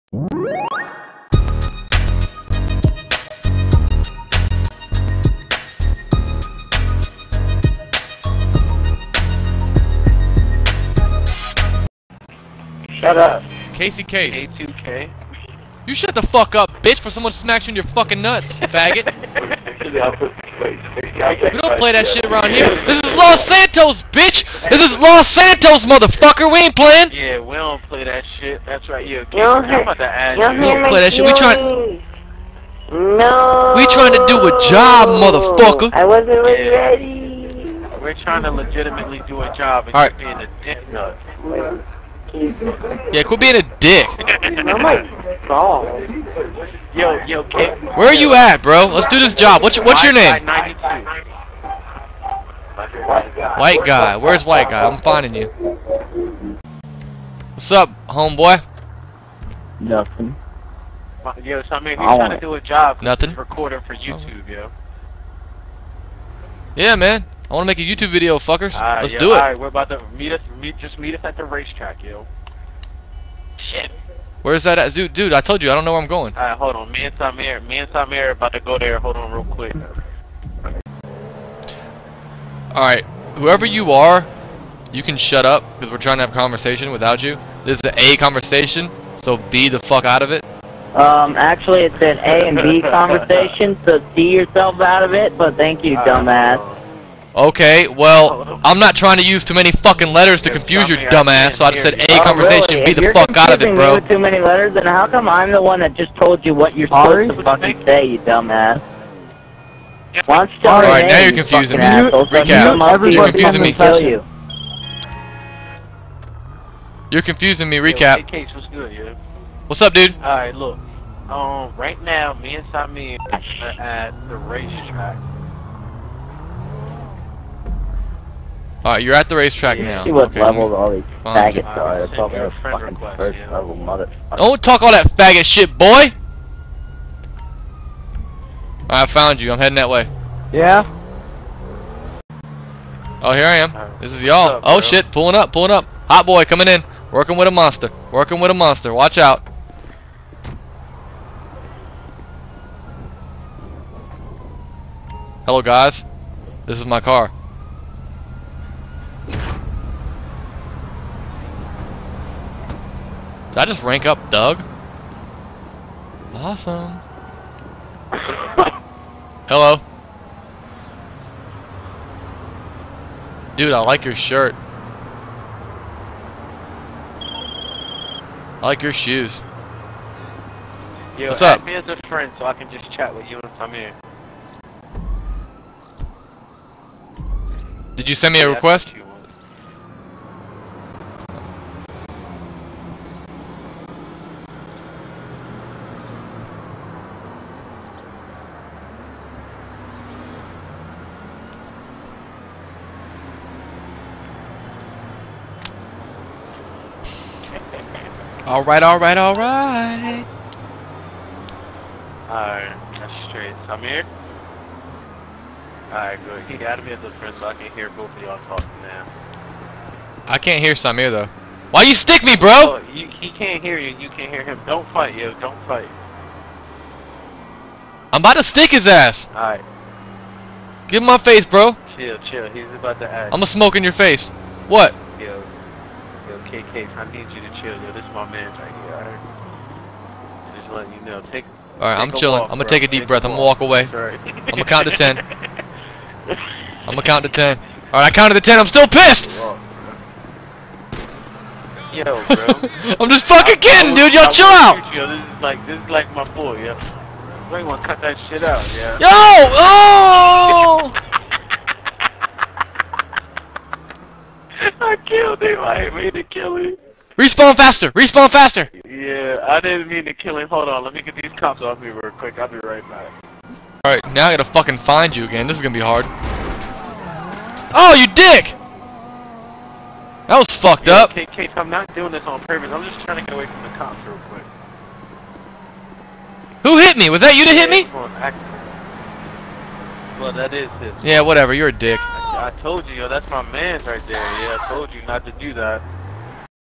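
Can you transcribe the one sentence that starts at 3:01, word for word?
me as a friend so I can just chat with you once I'm here.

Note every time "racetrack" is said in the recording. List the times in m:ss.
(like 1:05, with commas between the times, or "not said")
1:11, 2:04, 2:09.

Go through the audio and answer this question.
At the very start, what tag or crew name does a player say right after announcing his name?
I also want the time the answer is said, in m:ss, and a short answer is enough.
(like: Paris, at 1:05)
K2K, at 0:14.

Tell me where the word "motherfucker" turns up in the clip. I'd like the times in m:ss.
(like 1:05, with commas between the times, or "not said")
0:25, 0:35, 2:13.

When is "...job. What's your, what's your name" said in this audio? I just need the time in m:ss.
0:49.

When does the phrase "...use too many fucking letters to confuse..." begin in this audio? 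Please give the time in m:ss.
1:39.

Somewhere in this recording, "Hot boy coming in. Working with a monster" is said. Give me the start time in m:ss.
2:26.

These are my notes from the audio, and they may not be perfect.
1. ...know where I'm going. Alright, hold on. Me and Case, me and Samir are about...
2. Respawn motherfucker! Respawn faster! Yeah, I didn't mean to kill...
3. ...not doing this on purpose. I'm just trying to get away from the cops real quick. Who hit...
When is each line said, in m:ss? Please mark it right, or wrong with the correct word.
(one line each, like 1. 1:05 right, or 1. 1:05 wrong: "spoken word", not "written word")
1. 1:15 wrong: "Samir", not "Case"
2. 4:27 wrong: "faster", not "motherfucker"
3. 4:41 right.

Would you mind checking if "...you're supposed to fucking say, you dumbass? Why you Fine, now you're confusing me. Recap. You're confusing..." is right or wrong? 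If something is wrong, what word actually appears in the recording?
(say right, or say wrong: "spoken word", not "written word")
wrong: "Alright", not "Fine".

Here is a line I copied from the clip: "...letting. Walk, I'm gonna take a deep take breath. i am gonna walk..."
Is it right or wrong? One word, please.
wrong.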